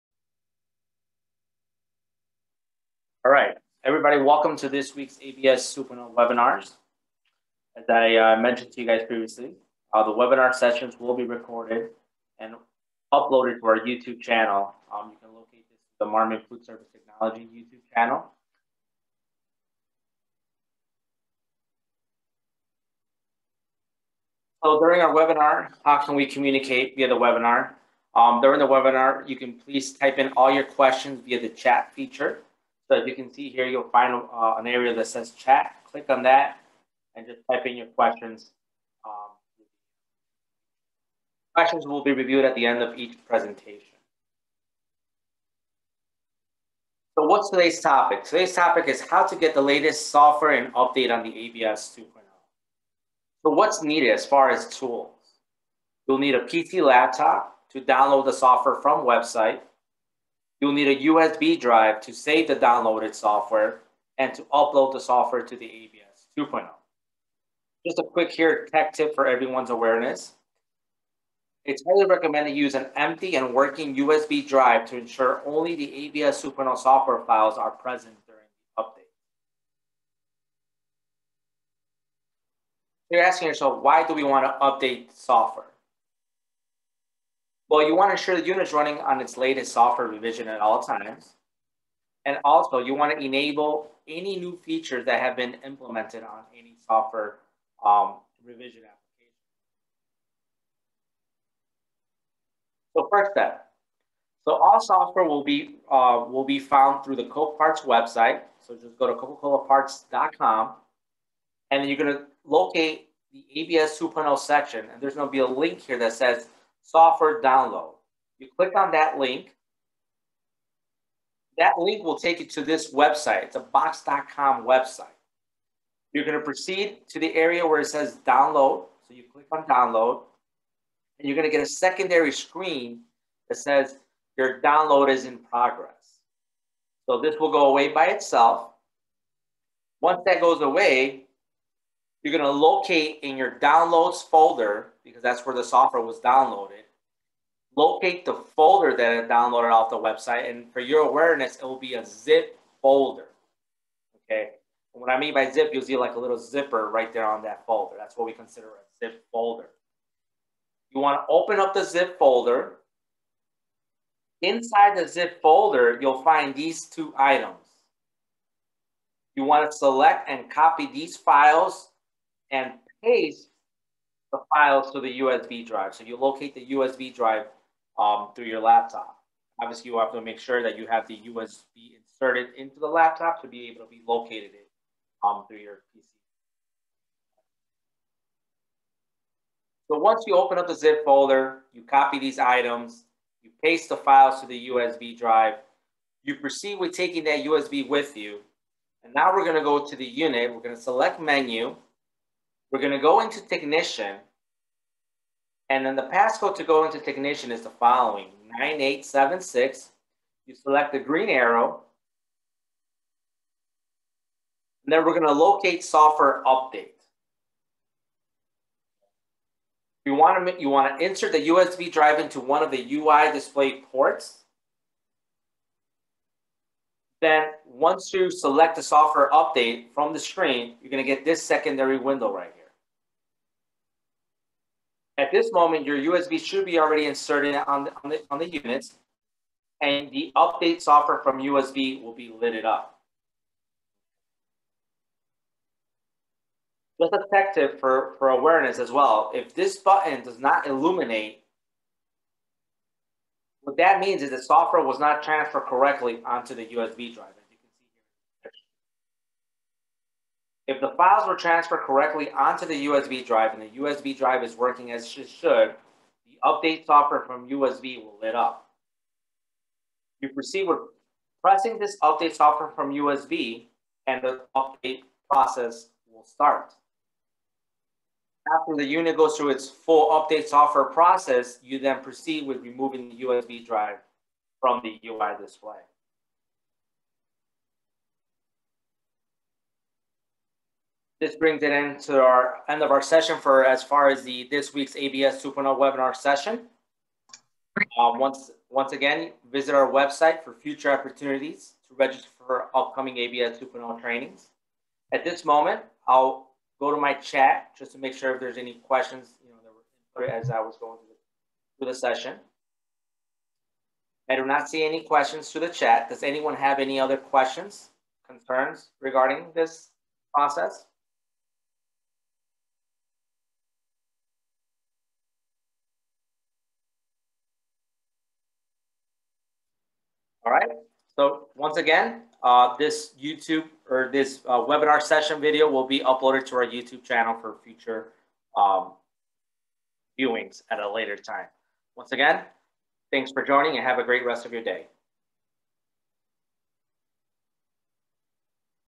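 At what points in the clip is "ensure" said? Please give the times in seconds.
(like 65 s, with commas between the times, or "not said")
74 s, 88 s.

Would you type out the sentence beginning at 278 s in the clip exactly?
After the unit goes through its full update software process, you then proceed with removing the USB drive from the UI display.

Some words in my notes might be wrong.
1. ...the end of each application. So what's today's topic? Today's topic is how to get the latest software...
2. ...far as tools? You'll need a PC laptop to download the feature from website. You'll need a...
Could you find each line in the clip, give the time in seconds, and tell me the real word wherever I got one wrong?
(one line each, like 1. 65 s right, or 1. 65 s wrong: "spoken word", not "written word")
1. 42 s wrong: "presentation", not "application"
2. 54 s wrong: "software", not "feature".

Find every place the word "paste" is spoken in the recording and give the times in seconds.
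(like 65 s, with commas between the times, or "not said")
173 s, 193 s.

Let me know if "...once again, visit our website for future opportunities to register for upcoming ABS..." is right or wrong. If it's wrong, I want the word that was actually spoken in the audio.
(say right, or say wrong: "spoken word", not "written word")
right.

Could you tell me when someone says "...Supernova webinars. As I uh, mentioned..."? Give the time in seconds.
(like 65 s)
5 s.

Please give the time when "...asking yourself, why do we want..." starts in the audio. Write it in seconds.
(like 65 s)
83 s.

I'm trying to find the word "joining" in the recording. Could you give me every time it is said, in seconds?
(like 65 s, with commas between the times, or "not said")
343 s.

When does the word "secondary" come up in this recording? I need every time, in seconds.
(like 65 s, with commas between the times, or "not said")
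131 s, 231 s.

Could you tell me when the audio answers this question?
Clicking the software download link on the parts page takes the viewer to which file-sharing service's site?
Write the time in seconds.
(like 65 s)
123 s.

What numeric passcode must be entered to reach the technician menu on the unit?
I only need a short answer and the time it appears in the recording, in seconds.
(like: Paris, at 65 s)
9876, at 208 s.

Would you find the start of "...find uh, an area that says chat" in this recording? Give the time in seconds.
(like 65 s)
33 s.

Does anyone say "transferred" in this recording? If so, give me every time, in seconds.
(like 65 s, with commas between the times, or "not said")
255 s, 261 s.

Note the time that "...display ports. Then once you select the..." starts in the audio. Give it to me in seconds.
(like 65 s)
223 s.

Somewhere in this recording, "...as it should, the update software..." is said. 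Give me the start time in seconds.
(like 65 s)
264 s.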